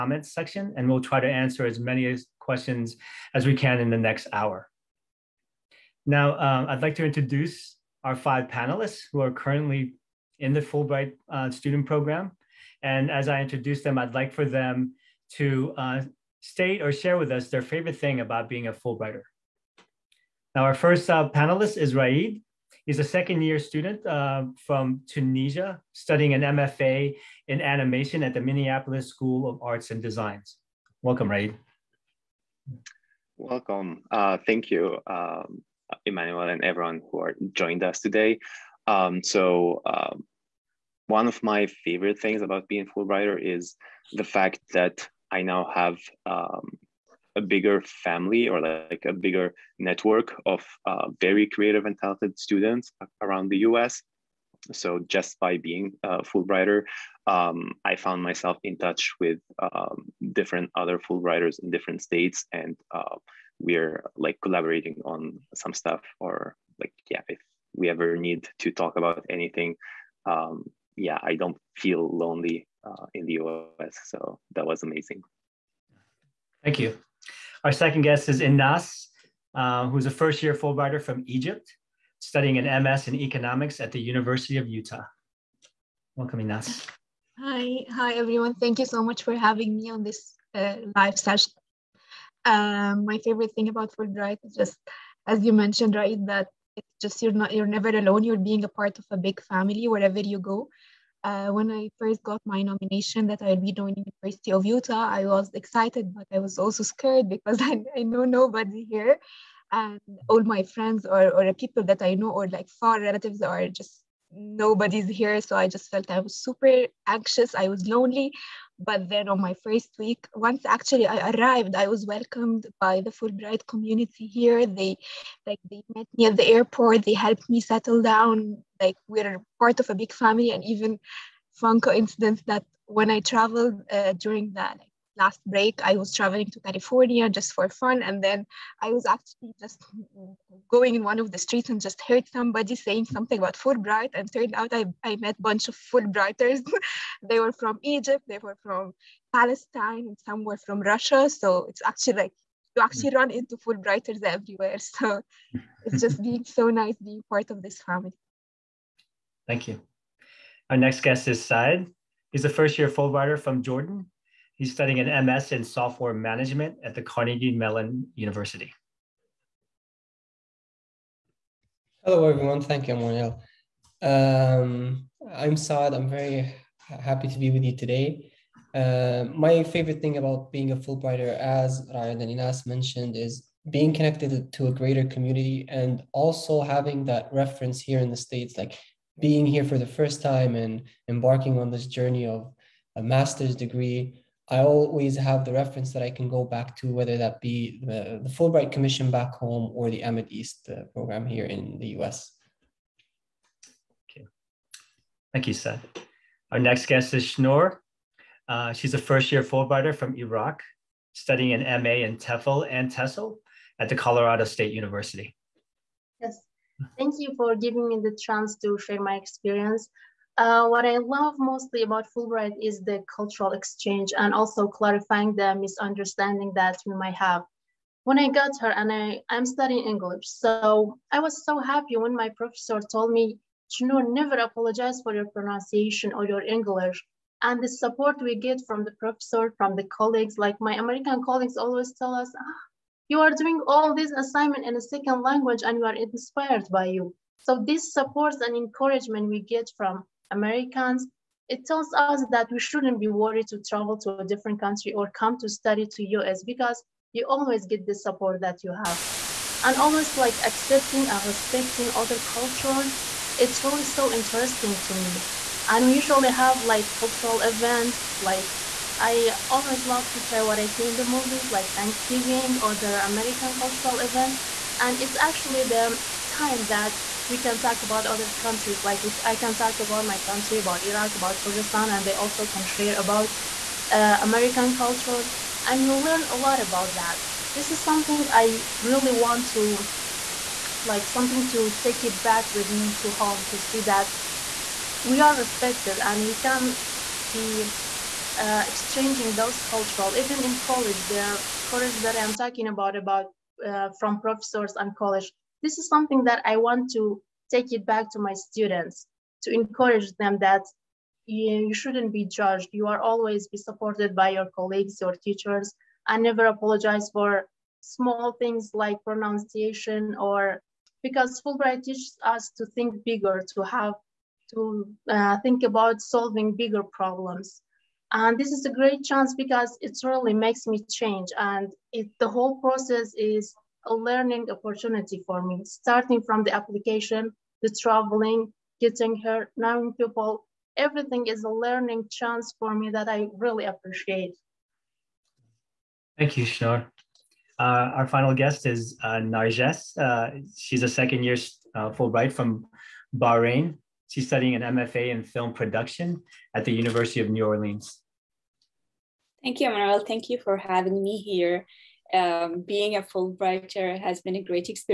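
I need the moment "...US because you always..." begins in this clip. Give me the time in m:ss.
4:16.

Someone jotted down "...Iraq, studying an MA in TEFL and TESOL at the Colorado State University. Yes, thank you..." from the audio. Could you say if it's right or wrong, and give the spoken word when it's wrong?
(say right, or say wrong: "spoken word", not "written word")
right.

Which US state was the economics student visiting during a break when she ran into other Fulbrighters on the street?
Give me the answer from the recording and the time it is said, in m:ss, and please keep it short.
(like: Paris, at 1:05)
California, at 2:16.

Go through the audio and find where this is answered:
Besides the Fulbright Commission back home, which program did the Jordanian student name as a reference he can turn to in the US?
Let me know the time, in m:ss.
3:20.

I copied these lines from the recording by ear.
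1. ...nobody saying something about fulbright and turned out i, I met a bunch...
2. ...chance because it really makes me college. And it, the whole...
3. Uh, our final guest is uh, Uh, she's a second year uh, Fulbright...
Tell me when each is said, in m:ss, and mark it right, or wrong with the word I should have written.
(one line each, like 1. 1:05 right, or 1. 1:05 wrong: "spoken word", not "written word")
1. 2:22 wrong: "somebody", not "nobody"
2. 5:29 wrong: "change", not "college"
3. 5:47 right.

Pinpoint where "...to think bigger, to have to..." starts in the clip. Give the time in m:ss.
5:22.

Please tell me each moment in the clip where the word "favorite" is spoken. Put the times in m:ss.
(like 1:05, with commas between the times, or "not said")
0:17, 0:41, 1:33, 2:59.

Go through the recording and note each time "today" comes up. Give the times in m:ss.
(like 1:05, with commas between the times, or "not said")
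0:37, 2:57.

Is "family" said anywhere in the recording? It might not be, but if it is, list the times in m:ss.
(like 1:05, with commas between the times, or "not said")
0:47, 1:39, 2:10, 2:37.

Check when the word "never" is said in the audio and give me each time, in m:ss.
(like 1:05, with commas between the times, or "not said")
1:37, 3:53, 5:16.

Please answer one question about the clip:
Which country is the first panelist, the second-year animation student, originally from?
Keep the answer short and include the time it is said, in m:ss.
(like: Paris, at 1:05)
Tunisia, at 0:25.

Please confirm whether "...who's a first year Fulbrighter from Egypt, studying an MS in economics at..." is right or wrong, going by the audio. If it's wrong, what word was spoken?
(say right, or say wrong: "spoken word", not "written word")
right.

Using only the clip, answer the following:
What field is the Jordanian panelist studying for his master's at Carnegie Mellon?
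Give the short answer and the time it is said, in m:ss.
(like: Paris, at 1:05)
Software management, at 2:45.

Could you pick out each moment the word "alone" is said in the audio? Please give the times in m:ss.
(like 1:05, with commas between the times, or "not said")
1:37.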